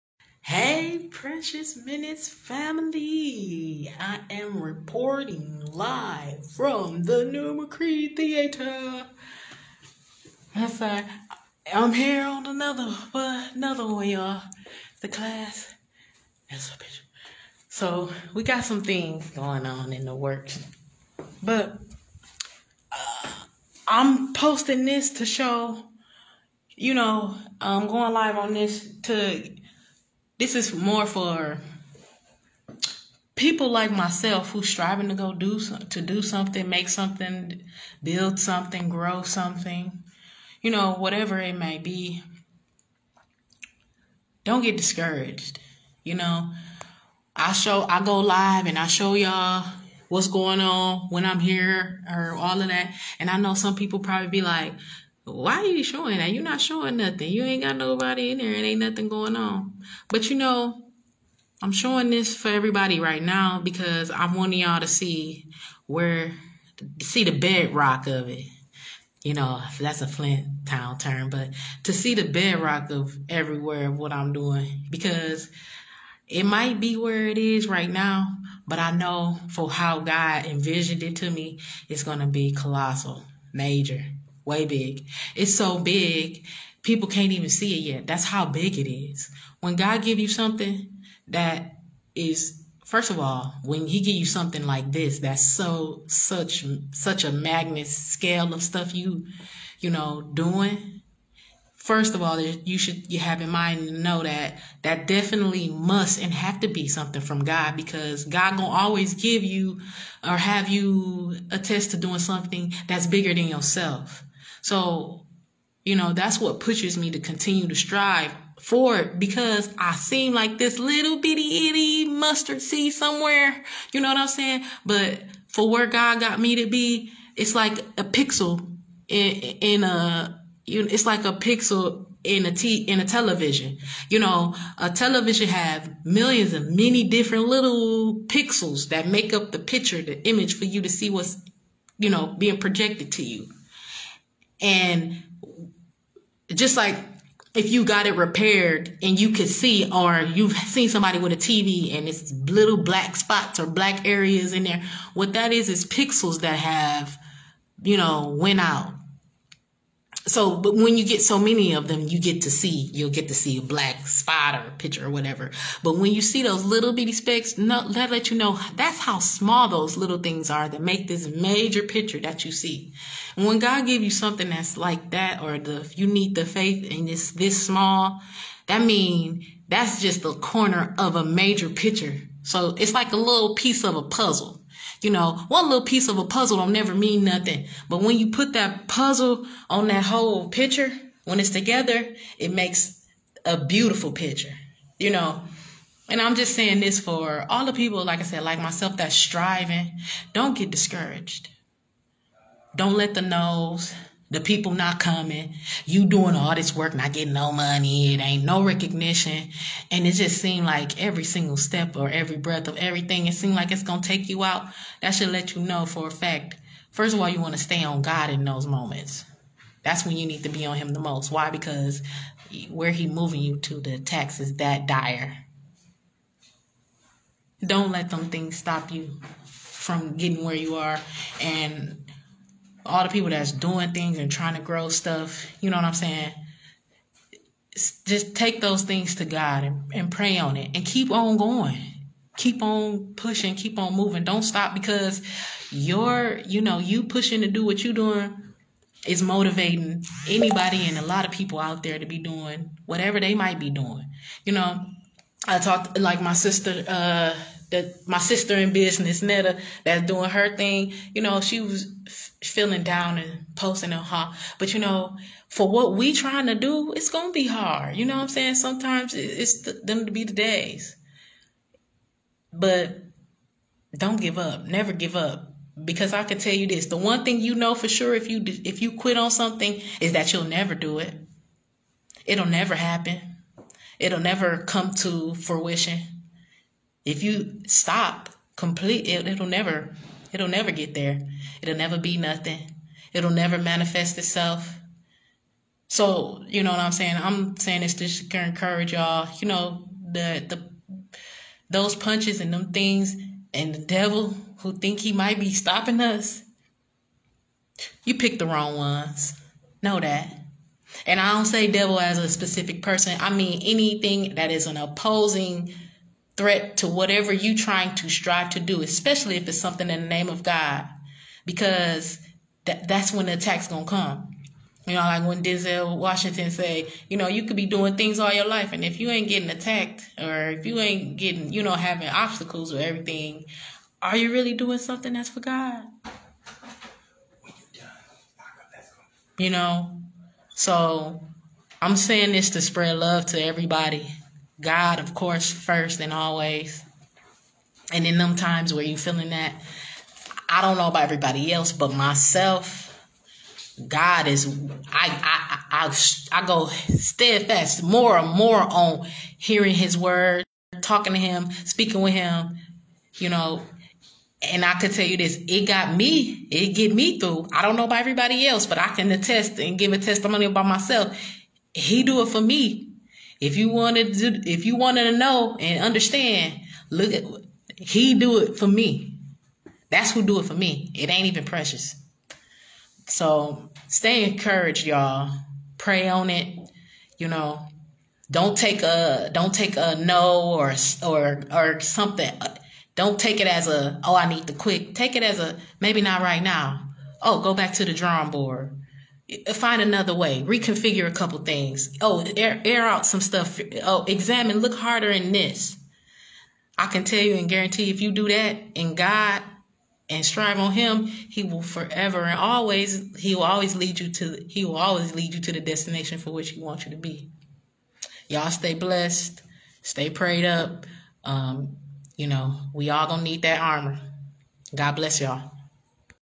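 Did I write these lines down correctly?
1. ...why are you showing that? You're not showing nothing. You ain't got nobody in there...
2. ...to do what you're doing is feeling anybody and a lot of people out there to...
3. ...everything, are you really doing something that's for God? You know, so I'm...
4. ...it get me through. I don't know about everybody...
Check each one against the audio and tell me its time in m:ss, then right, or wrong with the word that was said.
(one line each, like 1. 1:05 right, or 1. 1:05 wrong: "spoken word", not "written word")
1. 0:55 right
2. 4:07 wrong: "motivating", not "feeling"
3. 5:32 right
4. 6:06 right.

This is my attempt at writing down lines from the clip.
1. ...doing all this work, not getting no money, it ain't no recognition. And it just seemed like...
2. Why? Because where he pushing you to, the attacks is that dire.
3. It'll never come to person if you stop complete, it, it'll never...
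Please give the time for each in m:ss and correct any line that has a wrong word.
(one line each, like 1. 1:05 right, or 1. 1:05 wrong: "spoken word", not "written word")
1. 3:26 right
2. 3:41 wrong: "moving", not "pushing"
3. 4:43 wrong: "fruition", not "person".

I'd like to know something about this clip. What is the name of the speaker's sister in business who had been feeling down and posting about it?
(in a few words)
Netta.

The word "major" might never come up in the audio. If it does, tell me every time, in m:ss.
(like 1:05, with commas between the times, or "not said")
1:23, 2:51, 3:01.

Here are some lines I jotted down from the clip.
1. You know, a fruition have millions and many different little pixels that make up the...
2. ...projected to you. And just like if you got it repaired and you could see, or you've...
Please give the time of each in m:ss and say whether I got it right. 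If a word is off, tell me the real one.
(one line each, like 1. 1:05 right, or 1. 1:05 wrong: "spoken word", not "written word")
1. 2:14 wrong: "television", not "fruition"
2. 2:22 right.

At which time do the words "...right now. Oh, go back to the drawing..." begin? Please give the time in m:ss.
6:36.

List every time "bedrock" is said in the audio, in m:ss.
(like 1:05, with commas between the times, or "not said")
1:07, 1:12.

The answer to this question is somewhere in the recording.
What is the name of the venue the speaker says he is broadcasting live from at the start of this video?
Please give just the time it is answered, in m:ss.
0:07.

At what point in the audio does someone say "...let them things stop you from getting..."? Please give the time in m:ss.
3:47.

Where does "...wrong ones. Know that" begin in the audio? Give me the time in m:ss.
5:08.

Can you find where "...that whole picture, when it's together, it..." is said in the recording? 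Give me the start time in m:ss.
3:09.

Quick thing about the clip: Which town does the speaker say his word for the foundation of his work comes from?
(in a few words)
Flint.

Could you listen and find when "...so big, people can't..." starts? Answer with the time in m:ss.
1:25.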